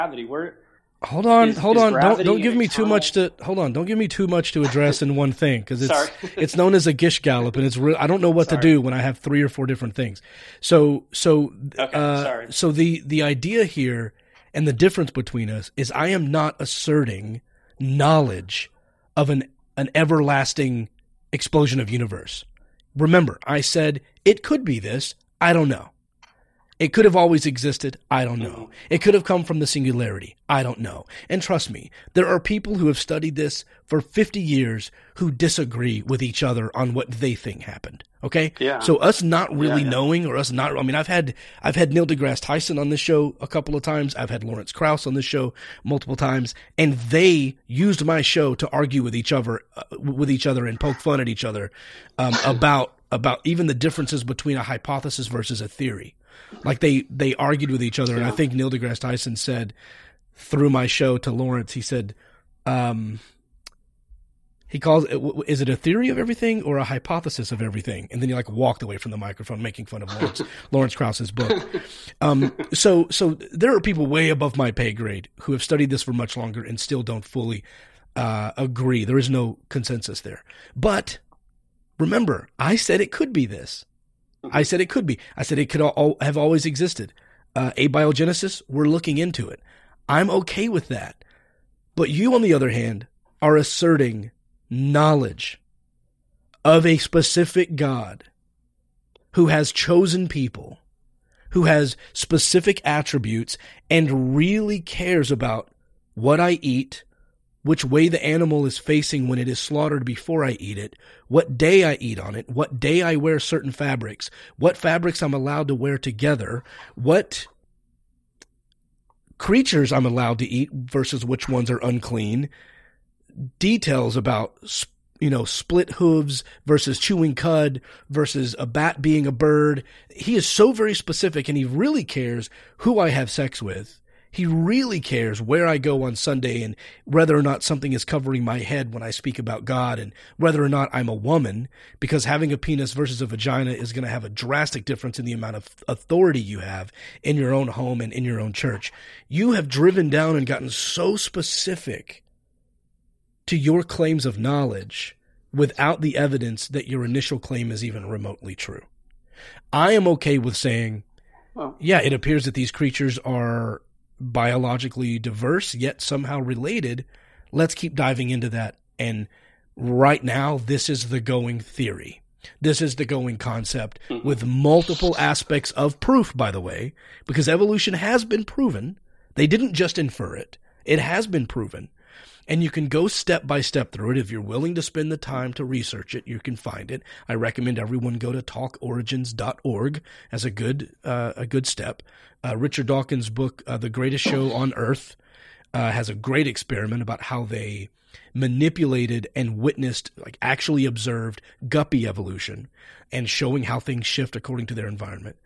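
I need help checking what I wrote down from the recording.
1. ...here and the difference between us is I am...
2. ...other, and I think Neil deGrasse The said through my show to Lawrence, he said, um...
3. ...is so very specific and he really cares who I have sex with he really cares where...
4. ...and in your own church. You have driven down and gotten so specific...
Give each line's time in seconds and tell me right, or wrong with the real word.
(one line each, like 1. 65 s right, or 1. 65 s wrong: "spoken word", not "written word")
1. 13 s right
2. 57 s wrong: "Tyson", not "The"
3. 130 s right
4. 148 s right.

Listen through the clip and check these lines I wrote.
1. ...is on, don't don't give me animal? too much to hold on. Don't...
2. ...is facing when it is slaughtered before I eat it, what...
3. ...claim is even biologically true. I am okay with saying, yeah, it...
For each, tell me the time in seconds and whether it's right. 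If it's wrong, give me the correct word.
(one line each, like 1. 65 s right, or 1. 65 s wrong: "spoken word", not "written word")
1. 1 s wrong: "eternal", not "animal"
2. 108 s right
3. 157 s wrong: "remotely", not "biologically".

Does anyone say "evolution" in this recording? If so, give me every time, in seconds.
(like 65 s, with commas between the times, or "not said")
177 s, 202 s.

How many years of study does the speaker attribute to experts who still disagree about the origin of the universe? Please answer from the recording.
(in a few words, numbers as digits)
50.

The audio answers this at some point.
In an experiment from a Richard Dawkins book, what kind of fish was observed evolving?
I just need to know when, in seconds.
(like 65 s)
201 s.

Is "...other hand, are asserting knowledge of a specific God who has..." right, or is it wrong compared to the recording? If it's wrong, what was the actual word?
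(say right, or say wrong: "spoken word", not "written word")
right.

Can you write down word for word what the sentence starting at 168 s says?
And right now, this is the going theory.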